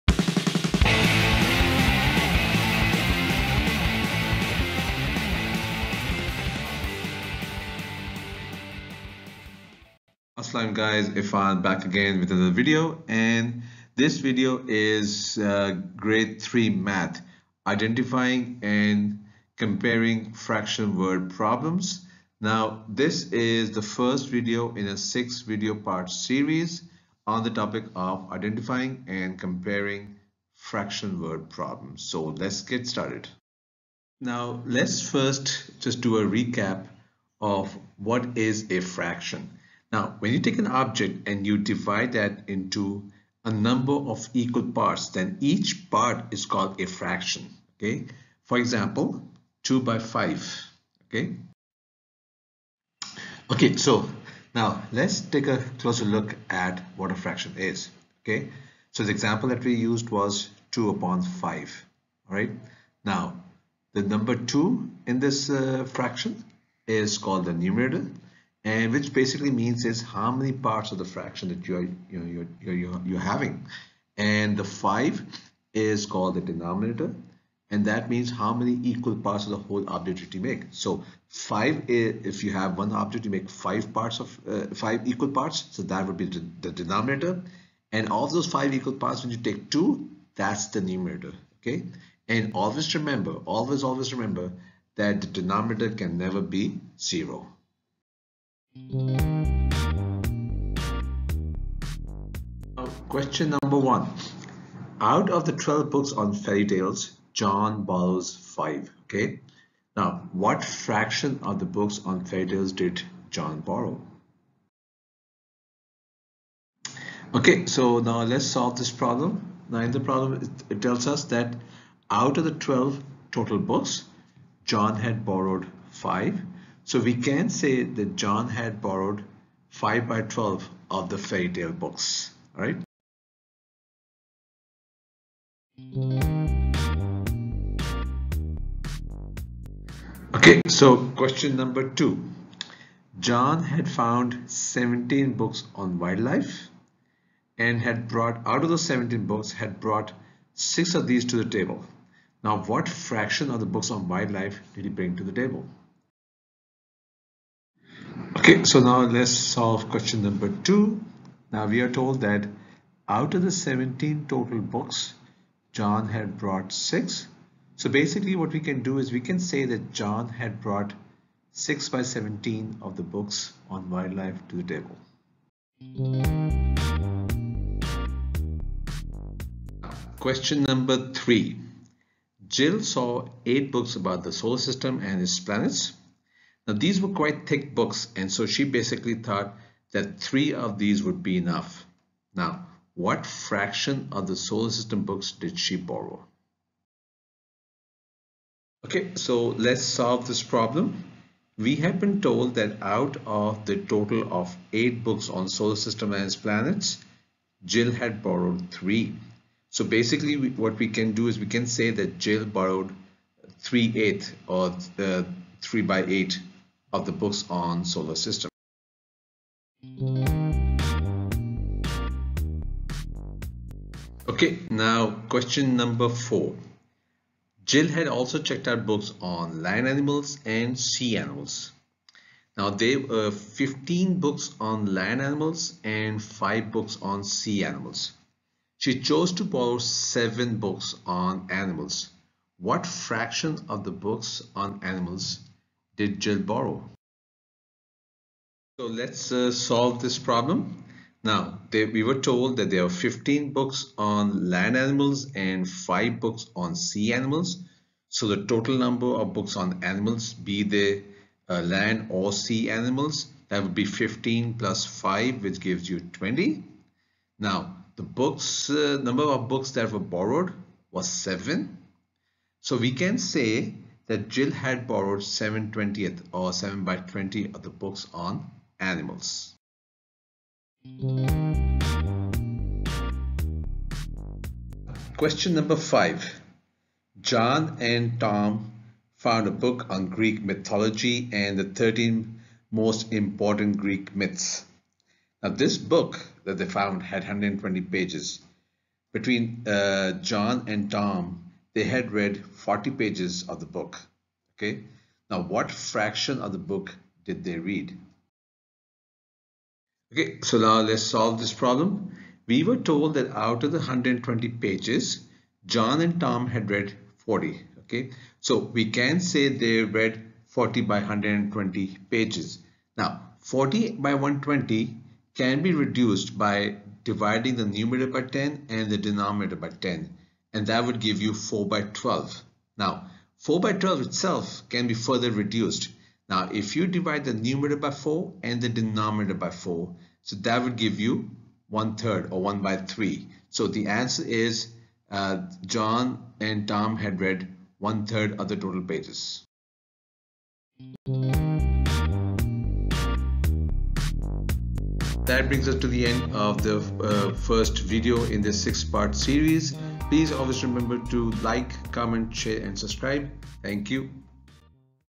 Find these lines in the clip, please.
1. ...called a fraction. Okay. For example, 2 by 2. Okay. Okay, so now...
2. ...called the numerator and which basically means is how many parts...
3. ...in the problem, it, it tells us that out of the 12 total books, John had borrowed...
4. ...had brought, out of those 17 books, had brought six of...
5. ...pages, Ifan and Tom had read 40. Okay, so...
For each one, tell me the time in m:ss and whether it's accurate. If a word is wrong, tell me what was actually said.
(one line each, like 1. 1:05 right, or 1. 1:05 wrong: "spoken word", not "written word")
1. 0:46 wrong: "5", not "2"
2. 1:07 right
3. 1:59 right
4. 2:27 right
5. 5:14 wrong: "John", not "Ifan".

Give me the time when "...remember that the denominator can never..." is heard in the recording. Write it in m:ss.
1:34.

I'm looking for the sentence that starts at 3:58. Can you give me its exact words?
She chose to borrow 7 books on animals.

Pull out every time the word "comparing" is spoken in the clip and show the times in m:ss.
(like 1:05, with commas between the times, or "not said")
0:19, 0:29.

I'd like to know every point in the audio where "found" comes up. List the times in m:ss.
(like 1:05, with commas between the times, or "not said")
2:23, 4:49, 4:56.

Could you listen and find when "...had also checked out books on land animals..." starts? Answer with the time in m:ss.
3:47.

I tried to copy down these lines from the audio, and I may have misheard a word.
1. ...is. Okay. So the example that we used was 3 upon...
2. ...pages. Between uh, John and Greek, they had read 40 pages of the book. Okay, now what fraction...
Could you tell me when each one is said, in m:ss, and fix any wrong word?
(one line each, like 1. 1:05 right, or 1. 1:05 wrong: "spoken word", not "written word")
1. 0:57 wrong: "2", not "3"
2. 4:57 wrong: "Tom", not "Greek".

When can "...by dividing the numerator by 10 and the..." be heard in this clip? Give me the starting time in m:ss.
5:26.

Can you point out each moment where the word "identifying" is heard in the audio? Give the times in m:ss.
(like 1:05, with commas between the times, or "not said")
0:17, 0:28.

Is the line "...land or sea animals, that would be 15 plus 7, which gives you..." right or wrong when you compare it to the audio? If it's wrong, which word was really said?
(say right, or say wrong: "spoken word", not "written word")
wrong: "5", not "7".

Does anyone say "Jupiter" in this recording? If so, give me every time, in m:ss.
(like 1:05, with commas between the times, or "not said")
not said.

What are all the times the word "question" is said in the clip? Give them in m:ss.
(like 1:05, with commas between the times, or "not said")
1:43, 2:21, 2:39, 3:00, 3:45, 4:45.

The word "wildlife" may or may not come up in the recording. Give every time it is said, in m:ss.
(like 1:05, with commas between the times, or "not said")
2:25, 2:34, 2:53.